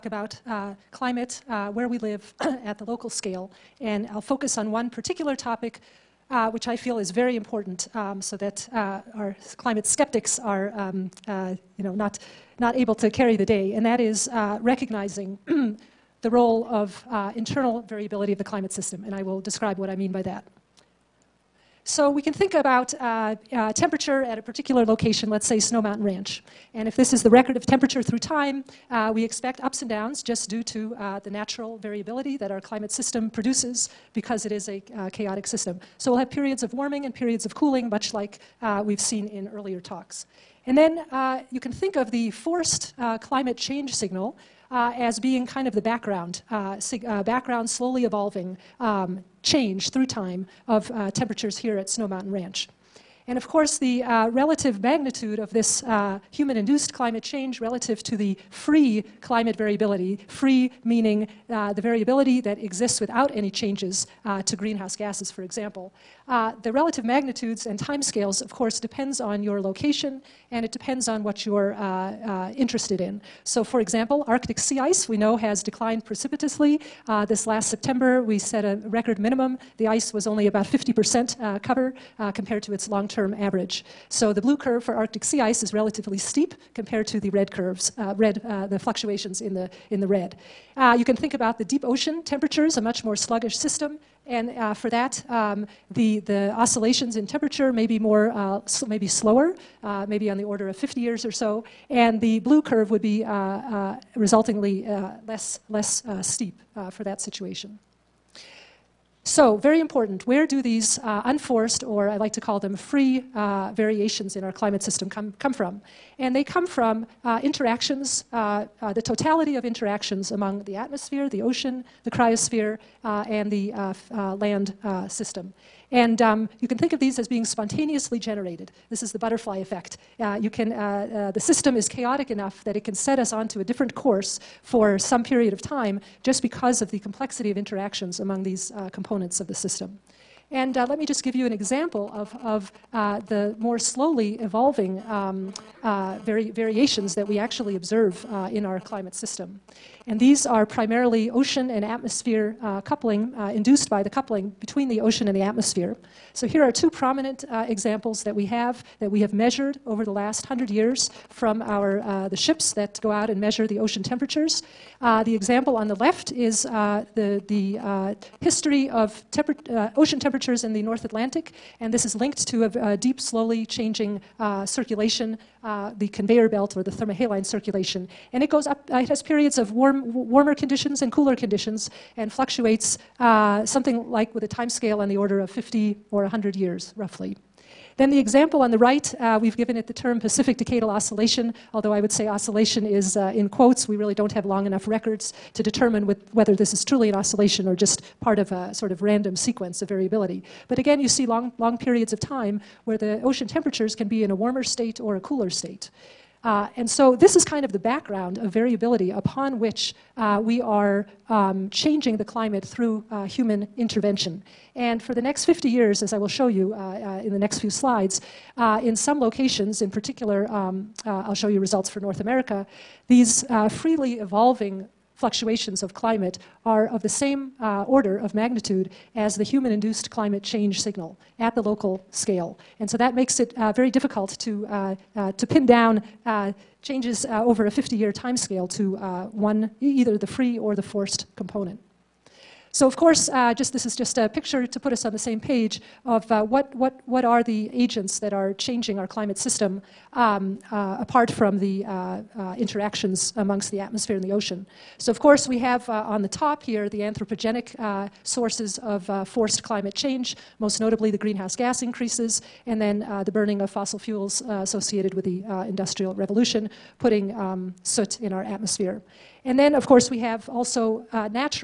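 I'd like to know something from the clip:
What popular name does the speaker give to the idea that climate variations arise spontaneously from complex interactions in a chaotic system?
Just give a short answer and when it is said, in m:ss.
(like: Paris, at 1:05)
butterfly effect, at 2:09.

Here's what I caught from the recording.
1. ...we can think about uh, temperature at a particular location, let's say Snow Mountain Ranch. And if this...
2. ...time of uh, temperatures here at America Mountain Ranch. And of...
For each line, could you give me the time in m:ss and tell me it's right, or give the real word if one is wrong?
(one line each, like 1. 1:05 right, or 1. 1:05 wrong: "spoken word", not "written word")
1. 0:22 right
2. 0:50 wrong: "Snow", not "America".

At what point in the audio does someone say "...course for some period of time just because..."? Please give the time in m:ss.
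2:13.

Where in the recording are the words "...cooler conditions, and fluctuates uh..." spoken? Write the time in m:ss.
3:01.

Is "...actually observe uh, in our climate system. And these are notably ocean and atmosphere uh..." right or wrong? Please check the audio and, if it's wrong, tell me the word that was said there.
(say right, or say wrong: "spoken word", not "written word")
wrong: "primarily", not "notably".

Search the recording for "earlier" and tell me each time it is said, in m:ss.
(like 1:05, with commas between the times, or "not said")
0:39.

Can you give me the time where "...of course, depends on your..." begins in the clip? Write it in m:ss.
1:08.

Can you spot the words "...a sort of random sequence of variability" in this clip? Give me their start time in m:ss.
3:18.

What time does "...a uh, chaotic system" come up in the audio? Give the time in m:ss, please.
0:34.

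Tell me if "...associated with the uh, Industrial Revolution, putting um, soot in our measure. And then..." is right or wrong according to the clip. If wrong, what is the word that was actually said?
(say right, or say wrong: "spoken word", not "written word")
wrong: "atmosphere", not "measure".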